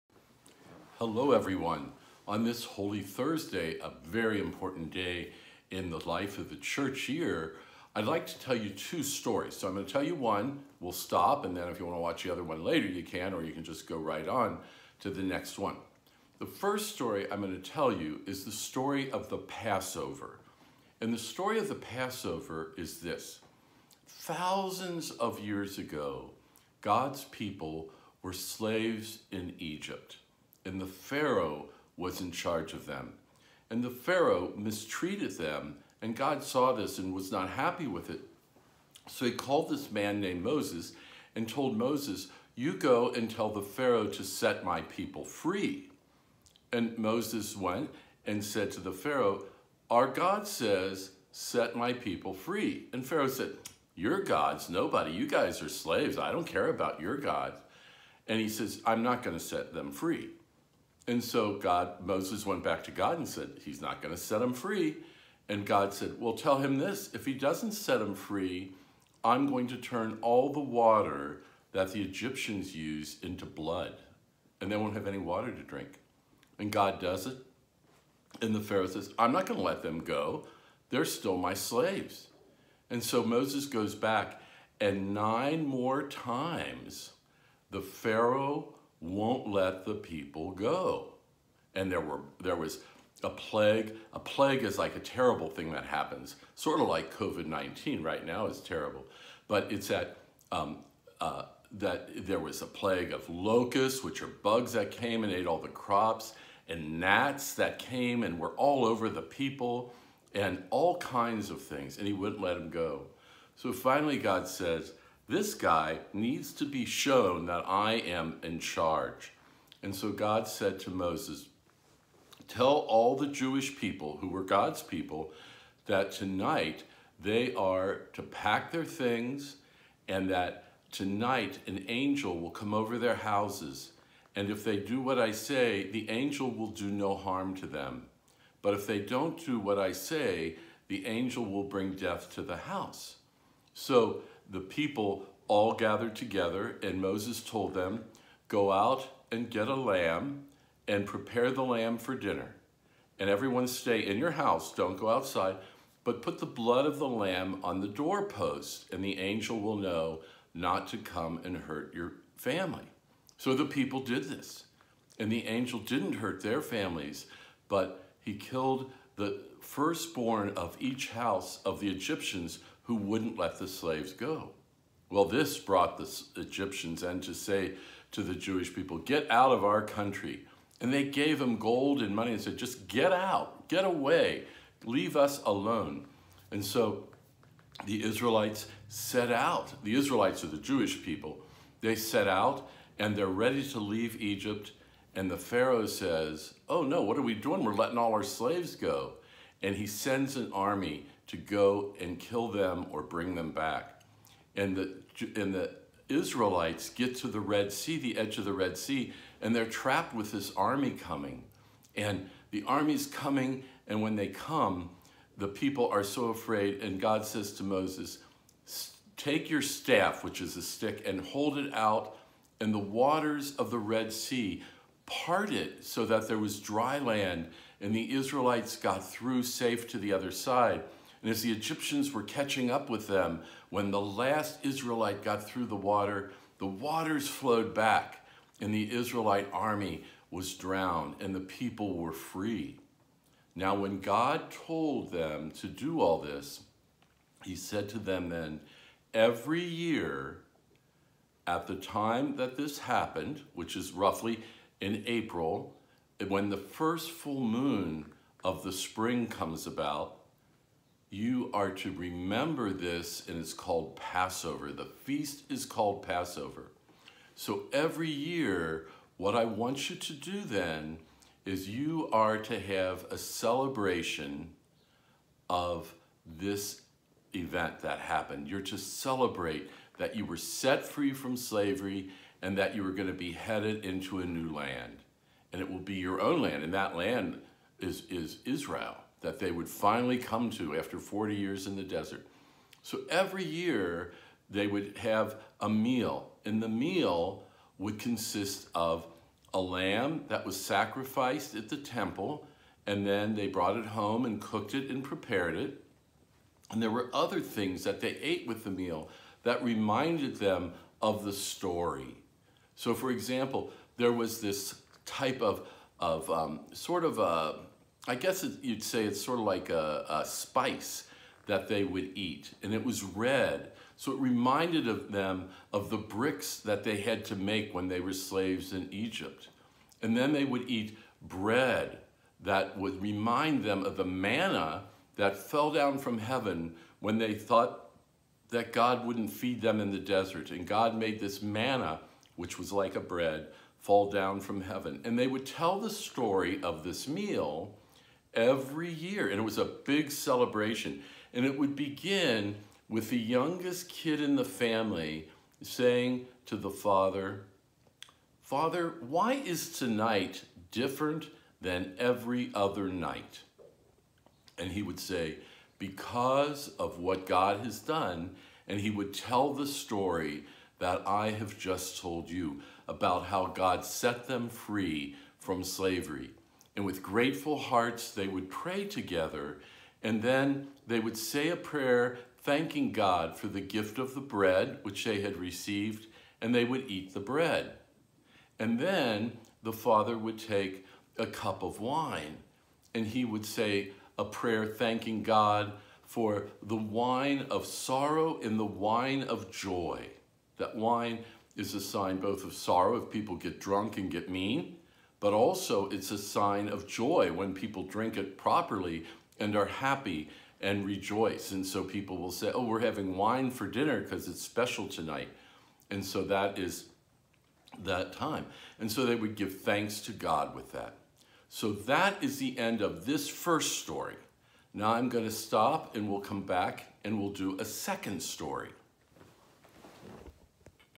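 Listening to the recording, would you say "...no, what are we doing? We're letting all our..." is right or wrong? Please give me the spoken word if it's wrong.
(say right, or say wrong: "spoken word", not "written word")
right.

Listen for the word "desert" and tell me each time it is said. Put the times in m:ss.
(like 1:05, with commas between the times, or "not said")
4:51, 5:39.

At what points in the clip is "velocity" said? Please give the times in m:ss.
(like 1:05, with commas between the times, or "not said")
not said.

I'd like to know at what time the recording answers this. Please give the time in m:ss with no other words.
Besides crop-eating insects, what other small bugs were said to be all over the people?
1:46.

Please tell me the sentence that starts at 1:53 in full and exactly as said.
So finally God says, this guy needs to be shown that I am in charge.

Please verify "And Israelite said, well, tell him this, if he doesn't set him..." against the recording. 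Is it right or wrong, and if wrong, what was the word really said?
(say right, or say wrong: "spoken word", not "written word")
wrong: "God", not "Israelite".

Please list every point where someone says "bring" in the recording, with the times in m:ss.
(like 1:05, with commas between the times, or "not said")
2:21, 3:23.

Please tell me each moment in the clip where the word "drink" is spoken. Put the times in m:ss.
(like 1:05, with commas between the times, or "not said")
1:15, 6:47.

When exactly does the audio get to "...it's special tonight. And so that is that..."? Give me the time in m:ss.
6:54.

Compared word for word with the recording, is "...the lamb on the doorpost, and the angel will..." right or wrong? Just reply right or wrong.
right.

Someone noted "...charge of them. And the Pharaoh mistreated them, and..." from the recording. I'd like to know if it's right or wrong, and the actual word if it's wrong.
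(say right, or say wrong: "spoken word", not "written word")
right.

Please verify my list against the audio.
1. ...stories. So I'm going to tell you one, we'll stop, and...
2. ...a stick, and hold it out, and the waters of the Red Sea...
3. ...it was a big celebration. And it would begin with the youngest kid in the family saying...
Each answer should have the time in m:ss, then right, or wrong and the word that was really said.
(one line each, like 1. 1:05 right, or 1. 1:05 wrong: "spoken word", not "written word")
1. 0:09 right
2. 3:40 right
3. 5:49 right.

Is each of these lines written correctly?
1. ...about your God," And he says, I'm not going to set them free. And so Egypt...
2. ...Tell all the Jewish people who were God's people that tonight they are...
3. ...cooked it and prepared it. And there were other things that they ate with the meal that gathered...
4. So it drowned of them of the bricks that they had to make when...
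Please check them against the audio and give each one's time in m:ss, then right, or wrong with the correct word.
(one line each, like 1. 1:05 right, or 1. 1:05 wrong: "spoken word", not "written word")
1. 0:56 wrong: "God", not "Egypt"
2. 2:02 right
3. 5:04 wrong: "reminded", not "gathered"
4. 5:23 wrong: "reminded", not "drowned".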